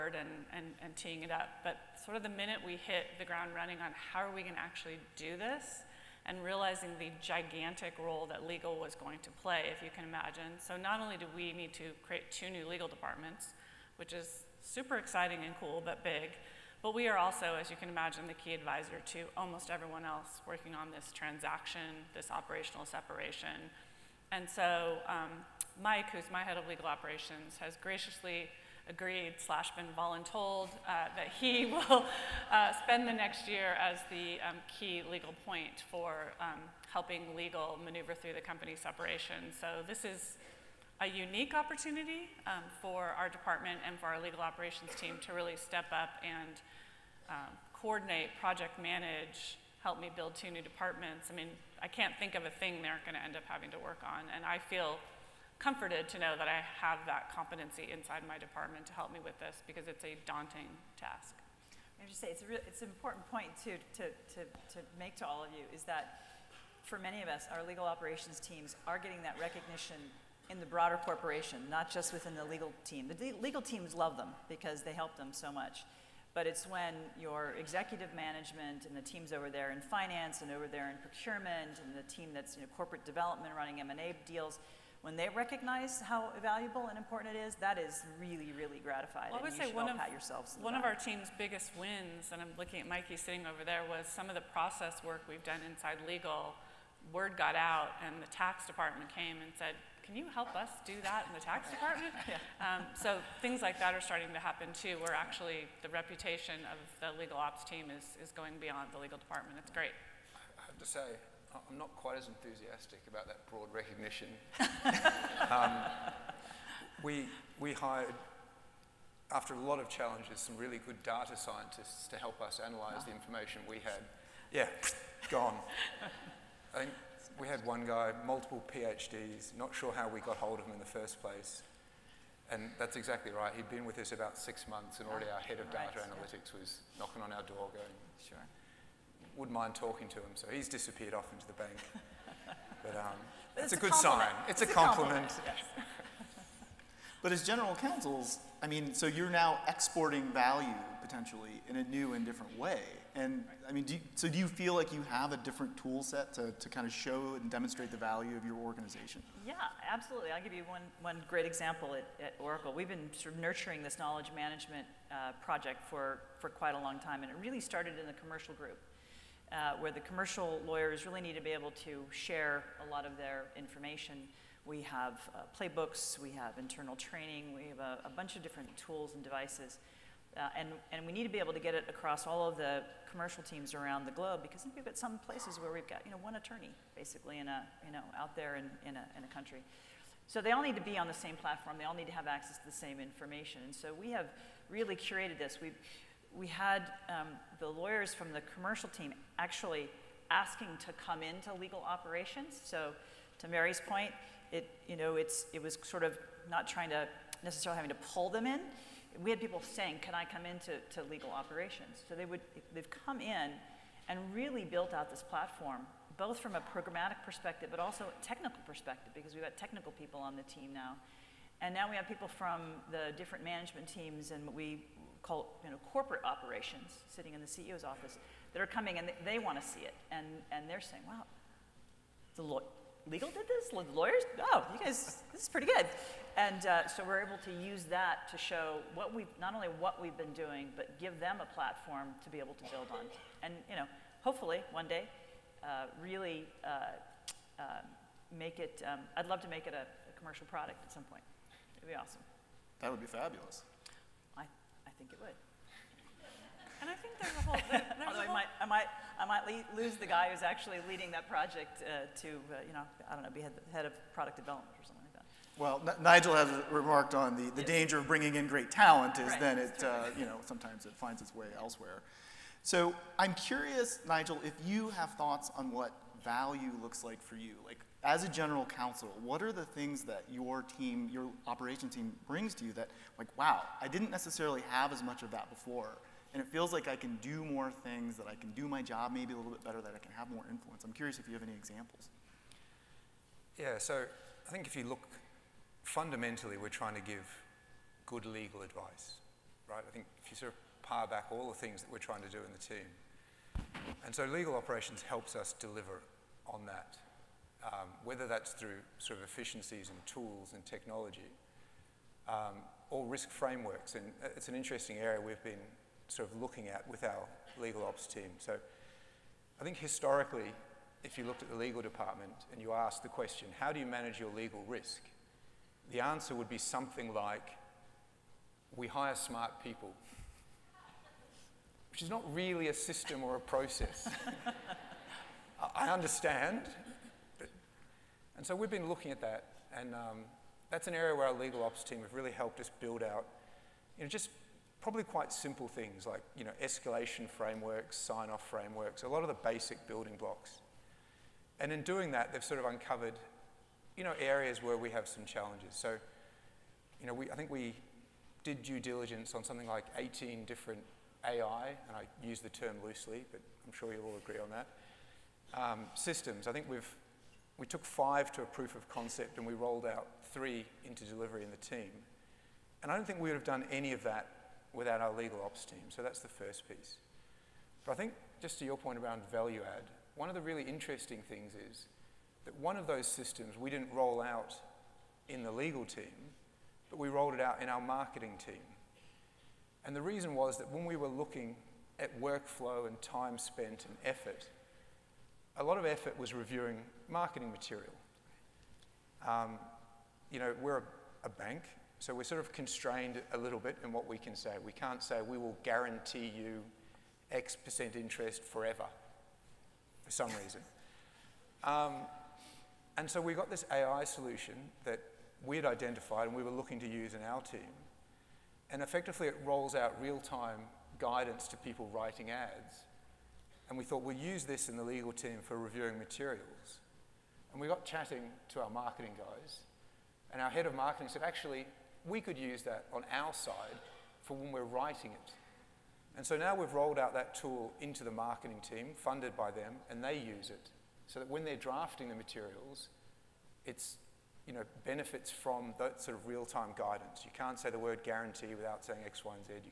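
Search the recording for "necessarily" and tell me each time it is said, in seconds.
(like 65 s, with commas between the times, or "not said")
207 s, 284 s.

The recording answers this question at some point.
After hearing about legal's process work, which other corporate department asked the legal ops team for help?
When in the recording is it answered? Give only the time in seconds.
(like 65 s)
98 s.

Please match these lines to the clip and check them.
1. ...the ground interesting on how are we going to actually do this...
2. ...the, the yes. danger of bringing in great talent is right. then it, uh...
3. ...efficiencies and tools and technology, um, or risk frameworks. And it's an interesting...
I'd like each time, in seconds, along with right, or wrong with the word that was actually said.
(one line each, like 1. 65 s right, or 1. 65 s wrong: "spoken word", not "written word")
1. 3 s wrong: "running", not "interesting"
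2. 267 s right
3. 309 s right.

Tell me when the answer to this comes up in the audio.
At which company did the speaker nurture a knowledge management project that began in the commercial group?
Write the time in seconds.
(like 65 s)
162 s.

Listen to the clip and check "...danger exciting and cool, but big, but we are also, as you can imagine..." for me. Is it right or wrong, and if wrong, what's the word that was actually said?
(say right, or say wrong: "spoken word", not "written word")
wrong: "super", not "danger".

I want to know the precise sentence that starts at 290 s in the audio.
I'm curious if you have any examples.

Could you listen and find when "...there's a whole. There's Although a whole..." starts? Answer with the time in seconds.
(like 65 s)
257 s.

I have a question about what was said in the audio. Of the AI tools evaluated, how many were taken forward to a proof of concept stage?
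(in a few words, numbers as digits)
5.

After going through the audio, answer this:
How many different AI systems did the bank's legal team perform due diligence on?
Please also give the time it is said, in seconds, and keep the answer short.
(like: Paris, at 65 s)
18, at 359 s.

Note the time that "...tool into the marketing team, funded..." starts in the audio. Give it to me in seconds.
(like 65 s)
437 s.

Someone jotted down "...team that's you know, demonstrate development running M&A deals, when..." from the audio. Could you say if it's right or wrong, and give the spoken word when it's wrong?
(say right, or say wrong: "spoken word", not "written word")
wrong: "corporate", not "demonstrate".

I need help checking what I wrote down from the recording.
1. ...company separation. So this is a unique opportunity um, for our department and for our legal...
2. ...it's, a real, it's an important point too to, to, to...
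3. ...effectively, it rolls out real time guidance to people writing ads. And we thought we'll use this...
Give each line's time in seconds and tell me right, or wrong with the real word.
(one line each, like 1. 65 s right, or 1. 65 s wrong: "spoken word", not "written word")
1. 38 s right
2. 62 s right
3. 418 s right.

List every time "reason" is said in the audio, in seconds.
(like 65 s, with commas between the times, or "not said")
390 s, 410 s.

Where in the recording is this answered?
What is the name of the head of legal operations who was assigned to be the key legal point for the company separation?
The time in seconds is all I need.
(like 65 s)
25 s.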